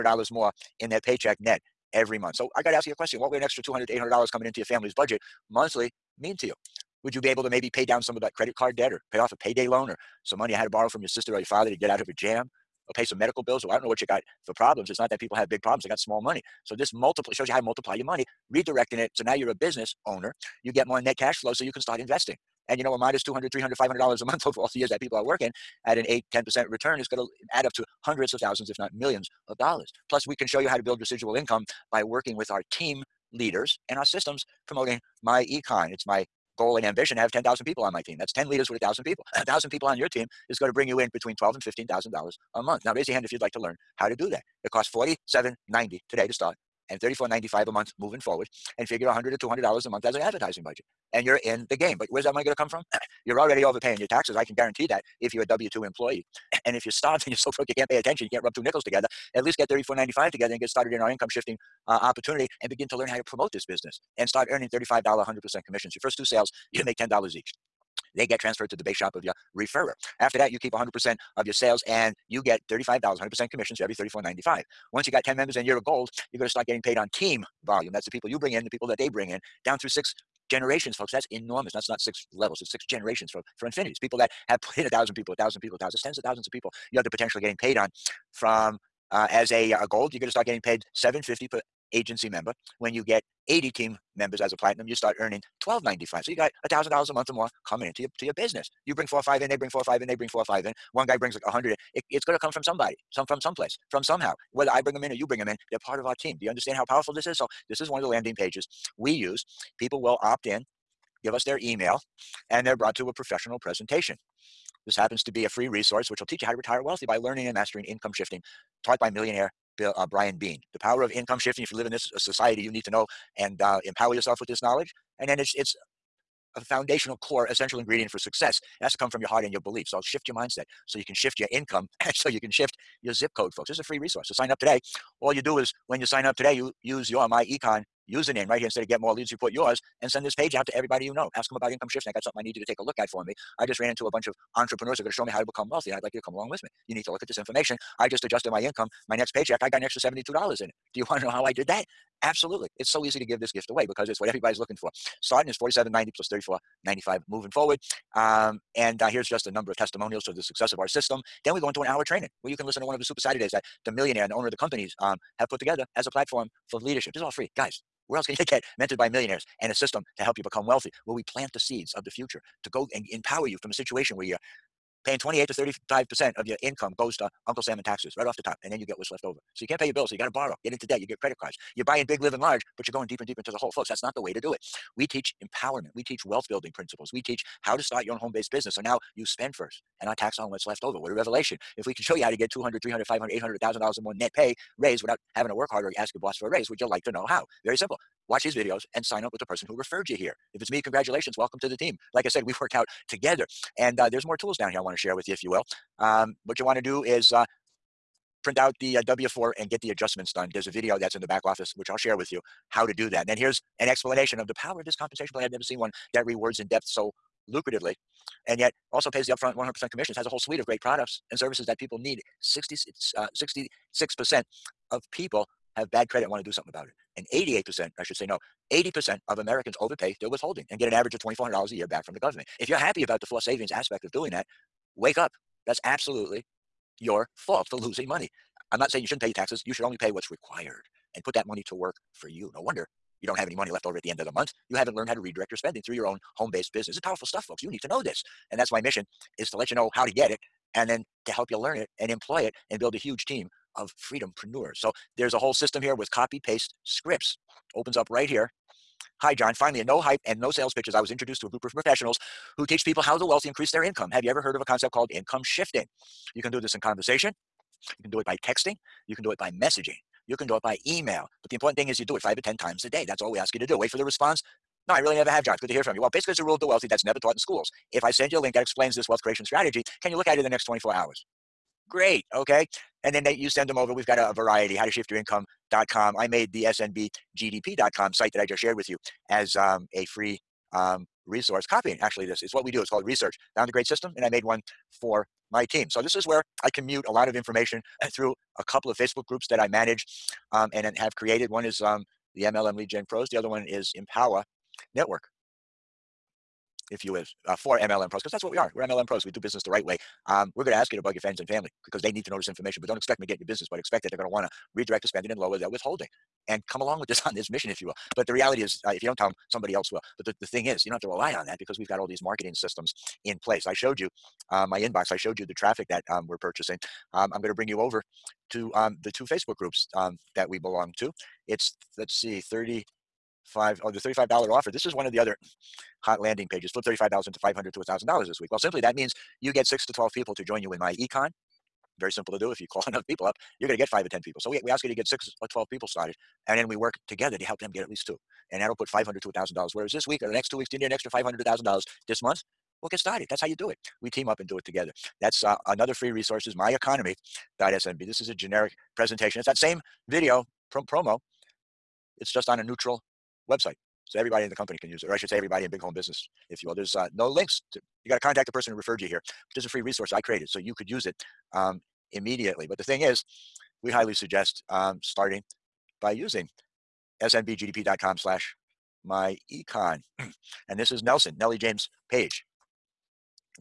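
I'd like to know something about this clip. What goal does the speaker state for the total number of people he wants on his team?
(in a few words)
10,000.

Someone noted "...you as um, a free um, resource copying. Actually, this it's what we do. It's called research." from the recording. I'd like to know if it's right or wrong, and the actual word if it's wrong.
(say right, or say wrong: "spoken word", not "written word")
right.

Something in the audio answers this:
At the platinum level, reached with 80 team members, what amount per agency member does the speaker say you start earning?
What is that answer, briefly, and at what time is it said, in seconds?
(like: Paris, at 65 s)
12.95, at 95 s.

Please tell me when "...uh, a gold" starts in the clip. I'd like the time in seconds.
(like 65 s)
89 s.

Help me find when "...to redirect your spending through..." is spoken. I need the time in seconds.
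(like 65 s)
245 s.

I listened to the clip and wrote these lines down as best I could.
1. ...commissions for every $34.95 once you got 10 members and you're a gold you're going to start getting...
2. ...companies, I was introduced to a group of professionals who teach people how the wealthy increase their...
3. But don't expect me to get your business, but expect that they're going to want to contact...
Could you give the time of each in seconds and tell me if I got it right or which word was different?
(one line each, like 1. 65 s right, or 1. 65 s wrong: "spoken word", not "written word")
1. 73 s right
2. 260 s wrong: "pitches", not "companies"
3. 312 s wrong: "redirect", not "contact".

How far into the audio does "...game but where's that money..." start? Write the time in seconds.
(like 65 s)
51 s.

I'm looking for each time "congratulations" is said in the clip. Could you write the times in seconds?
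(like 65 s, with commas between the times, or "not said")
200 s.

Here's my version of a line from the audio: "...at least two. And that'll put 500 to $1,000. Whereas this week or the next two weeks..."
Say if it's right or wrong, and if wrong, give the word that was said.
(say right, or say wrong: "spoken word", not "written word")
right.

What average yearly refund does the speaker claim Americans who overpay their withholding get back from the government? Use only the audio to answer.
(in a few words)
$2,400.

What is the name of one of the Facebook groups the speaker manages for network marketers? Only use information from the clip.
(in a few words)
MLM Lead Gen Pros.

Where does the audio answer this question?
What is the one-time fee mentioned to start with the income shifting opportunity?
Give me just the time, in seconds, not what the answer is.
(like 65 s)
44 s.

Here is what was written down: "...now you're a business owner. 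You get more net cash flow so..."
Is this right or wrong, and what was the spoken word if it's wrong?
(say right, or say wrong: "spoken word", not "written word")
right.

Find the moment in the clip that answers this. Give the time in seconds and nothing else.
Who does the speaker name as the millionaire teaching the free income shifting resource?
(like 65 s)
120 s.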